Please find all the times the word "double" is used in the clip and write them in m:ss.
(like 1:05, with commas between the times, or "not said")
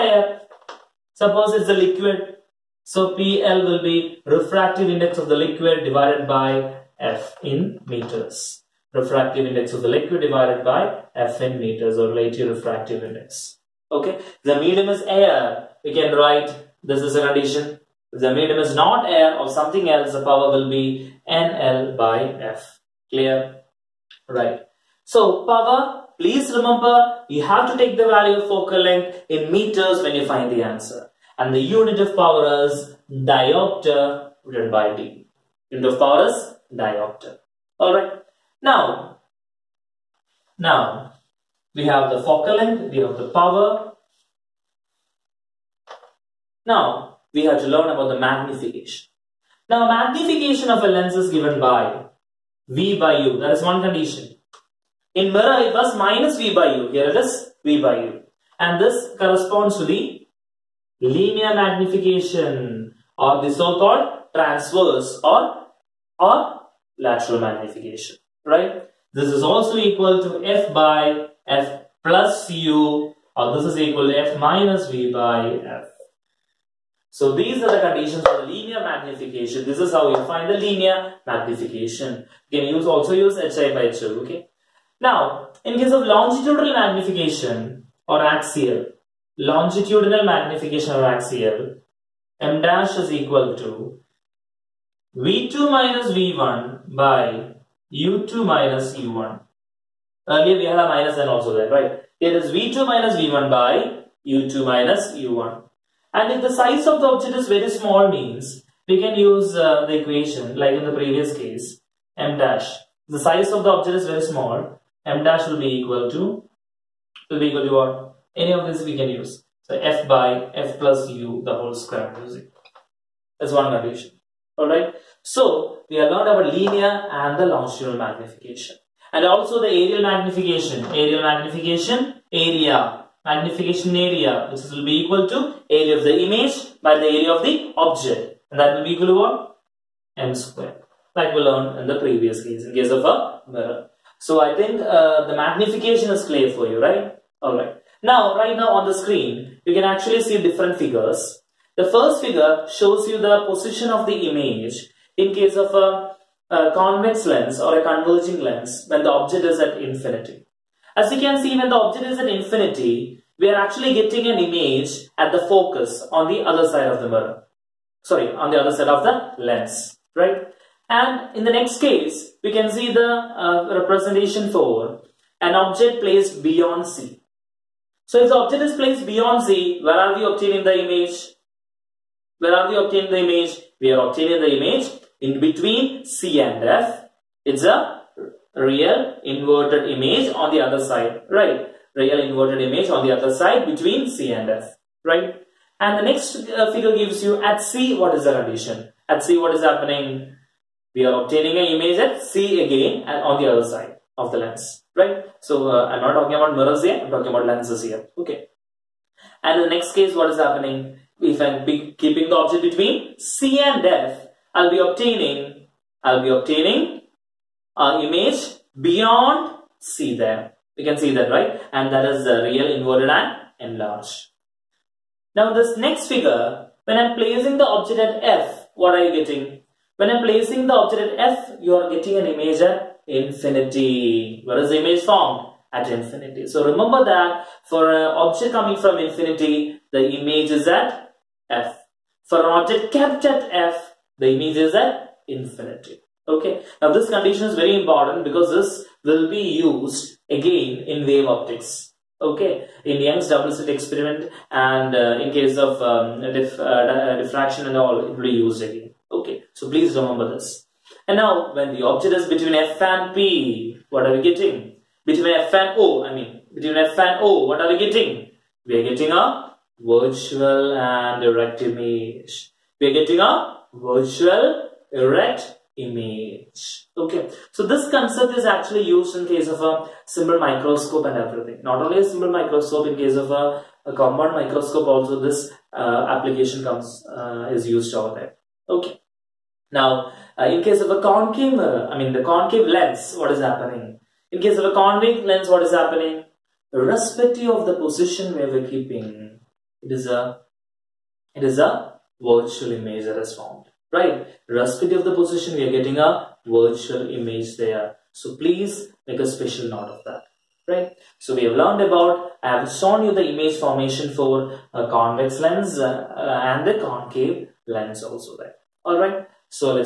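4:13.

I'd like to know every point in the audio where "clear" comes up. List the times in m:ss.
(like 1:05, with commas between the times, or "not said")
0:23, 2:26.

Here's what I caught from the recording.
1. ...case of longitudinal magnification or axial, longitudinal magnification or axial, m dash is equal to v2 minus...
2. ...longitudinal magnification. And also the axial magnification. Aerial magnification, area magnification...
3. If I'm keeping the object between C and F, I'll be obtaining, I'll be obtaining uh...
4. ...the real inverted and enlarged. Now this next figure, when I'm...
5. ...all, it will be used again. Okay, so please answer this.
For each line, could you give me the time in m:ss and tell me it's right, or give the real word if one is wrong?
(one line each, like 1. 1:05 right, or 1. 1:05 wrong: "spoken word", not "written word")
1. 1:25 right
2. 2:07 wrong: "aerial", not "axial"
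3. 3:31 right
4. 3:42 right
5. 4:17 wrong: "remember", not "answer".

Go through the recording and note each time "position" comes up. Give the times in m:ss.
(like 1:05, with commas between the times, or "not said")
2:33, 4:57, 5:05.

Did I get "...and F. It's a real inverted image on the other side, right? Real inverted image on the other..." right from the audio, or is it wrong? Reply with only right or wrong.
right.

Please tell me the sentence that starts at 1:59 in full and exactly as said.
So f by f plus u the whole square music.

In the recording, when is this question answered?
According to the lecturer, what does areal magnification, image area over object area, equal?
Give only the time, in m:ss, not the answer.
2:20.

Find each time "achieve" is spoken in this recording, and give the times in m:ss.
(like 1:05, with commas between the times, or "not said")
not said.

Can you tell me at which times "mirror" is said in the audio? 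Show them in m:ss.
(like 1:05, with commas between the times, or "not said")
0:55, 2:23, 2:47, 3:26, 4:51.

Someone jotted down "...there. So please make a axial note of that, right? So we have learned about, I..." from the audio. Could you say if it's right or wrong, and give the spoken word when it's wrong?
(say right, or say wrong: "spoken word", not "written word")
wrong: "special", not "axial".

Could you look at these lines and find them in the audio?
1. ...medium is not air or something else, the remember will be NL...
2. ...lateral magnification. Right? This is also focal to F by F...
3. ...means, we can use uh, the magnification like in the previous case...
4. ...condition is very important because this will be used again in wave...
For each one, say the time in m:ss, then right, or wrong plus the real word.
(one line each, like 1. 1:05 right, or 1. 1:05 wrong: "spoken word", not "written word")
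1. 0:18 wrong: "power", not "remember"
2. 1:06 wrong: "equal", not "focal"
3. 1:48 wrong: "equation", not "magnification"
4. 4:07 right.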